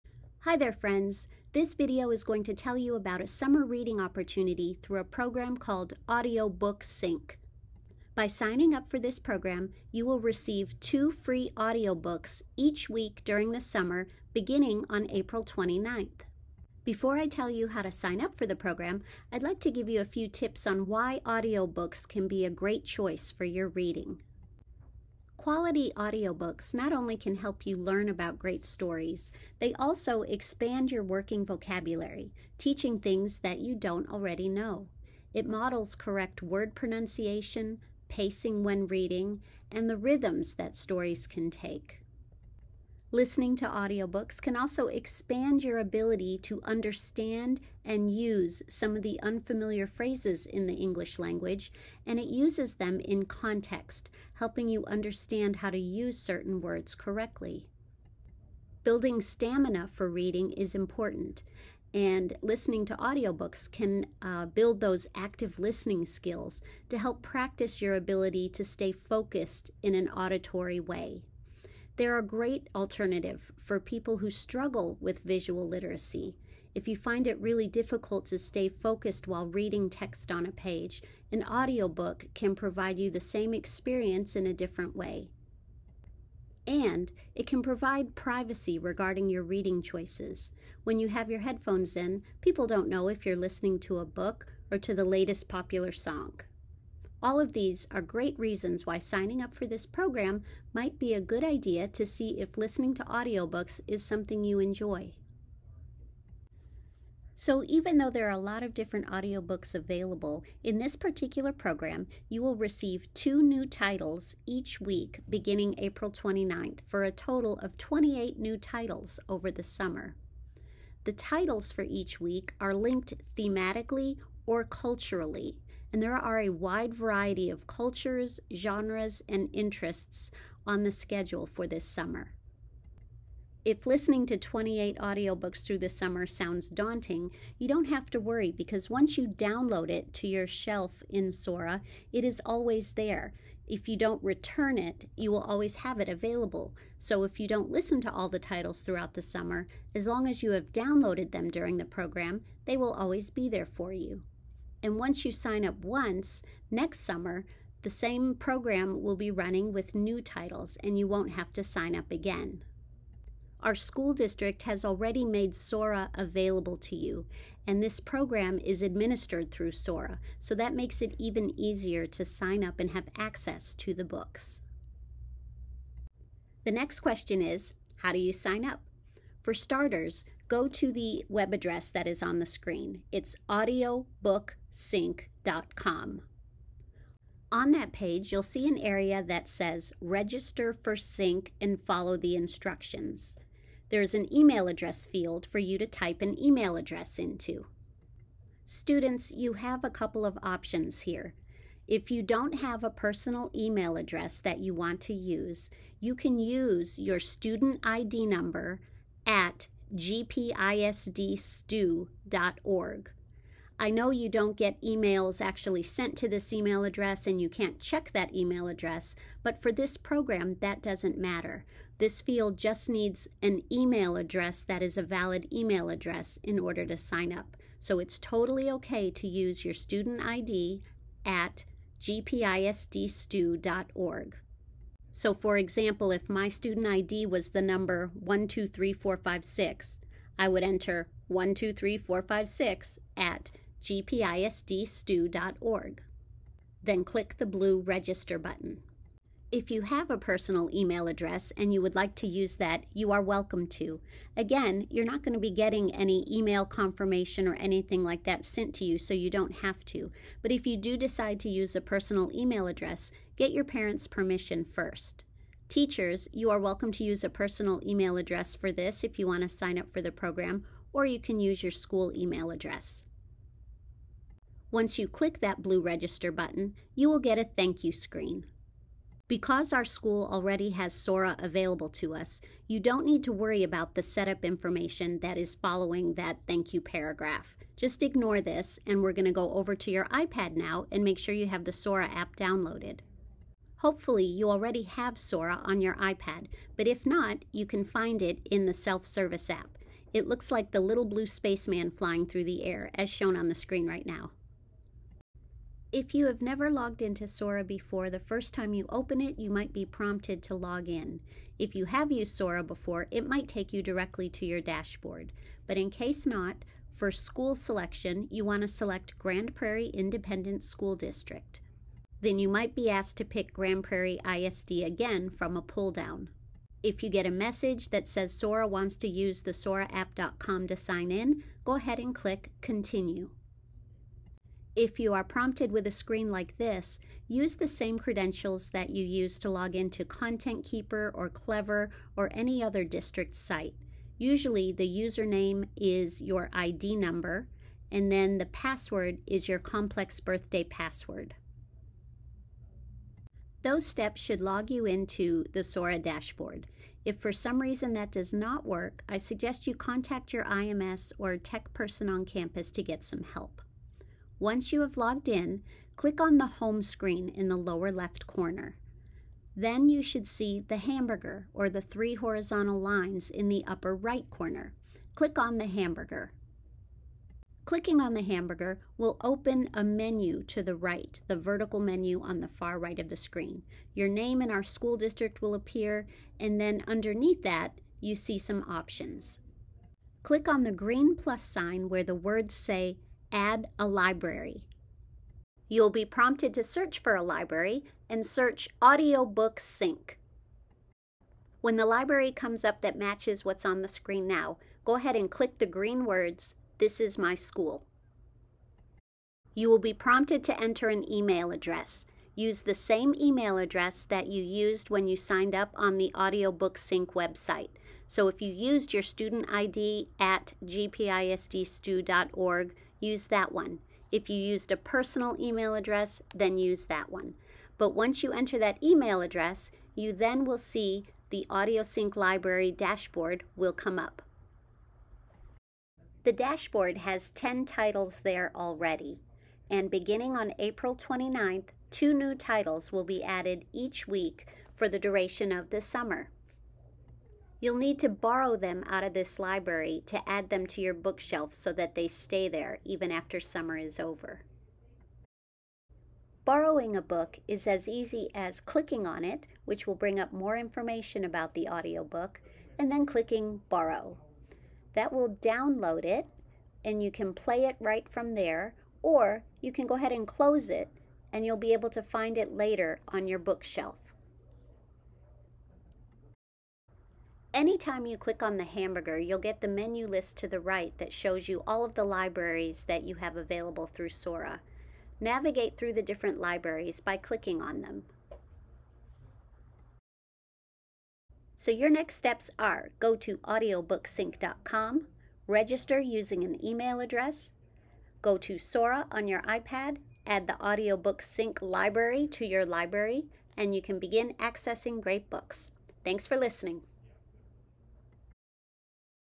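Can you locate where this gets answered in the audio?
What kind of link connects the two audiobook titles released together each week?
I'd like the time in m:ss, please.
2:03.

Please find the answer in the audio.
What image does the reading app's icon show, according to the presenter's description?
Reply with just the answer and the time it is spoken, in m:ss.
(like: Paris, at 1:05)
little blue spaceman, at 5:00.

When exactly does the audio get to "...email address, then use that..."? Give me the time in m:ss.
7:05.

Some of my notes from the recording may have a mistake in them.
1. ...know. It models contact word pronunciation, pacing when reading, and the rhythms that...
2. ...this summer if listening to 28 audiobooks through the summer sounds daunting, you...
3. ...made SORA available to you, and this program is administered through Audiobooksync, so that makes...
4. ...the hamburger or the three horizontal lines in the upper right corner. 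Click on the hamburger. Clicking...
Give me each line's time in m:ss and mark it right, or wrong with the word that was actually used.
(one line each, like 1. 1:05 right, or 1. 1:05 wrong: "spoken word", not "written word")
1. 0:34 wrong: "correct", not "contact"
2. 2:11 right
3. 2:45 wrong: "SORA", not "Audiobooksync"
4. 6:10 right.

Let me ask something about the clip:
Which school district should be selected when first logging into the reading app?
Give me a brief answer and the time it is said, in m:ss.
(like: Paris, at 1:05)
Grand Prairie Independent School District, at 5:19.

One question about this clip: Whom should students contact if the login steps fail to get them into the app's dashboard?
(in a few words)
IMS or tech person.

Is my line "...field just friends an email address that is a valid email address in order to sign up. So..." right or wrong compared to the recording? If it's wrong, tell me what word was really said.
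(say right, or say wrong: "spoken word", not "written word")
wrong: "needs", not "friends".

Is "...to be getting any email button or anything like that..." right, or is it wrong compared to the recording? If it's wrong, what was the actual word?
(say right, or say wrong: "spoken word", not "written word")
wrong: "confirmation", not "button".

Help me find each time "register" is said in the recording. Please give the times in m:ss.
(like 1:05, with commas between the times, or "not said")
3:10, 4:07, 4:35, 8:15.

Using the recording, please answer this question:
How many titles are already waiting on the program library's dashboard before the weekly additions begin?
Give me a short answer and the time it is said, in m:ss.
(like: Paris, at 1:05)
10, at 7:17.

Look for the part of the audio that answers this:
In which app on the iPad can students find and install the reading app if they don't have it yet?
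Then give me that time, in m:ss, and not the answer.
4:58.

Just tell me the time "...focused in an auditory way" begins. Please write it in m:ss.
1:08.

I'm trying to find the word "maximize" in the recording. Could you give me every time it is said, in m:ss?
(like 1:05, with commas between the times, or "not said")
not said.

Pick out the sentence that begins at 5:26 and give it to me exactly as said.
If you get a message that says Sora wants to use the SoraApp.com to sign in, go ahead and click Continue.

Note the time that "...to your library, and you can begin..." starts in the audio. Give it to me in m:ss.
8:22.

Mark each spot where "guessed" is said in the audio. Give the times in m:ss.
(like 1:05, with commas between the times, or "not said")
not said.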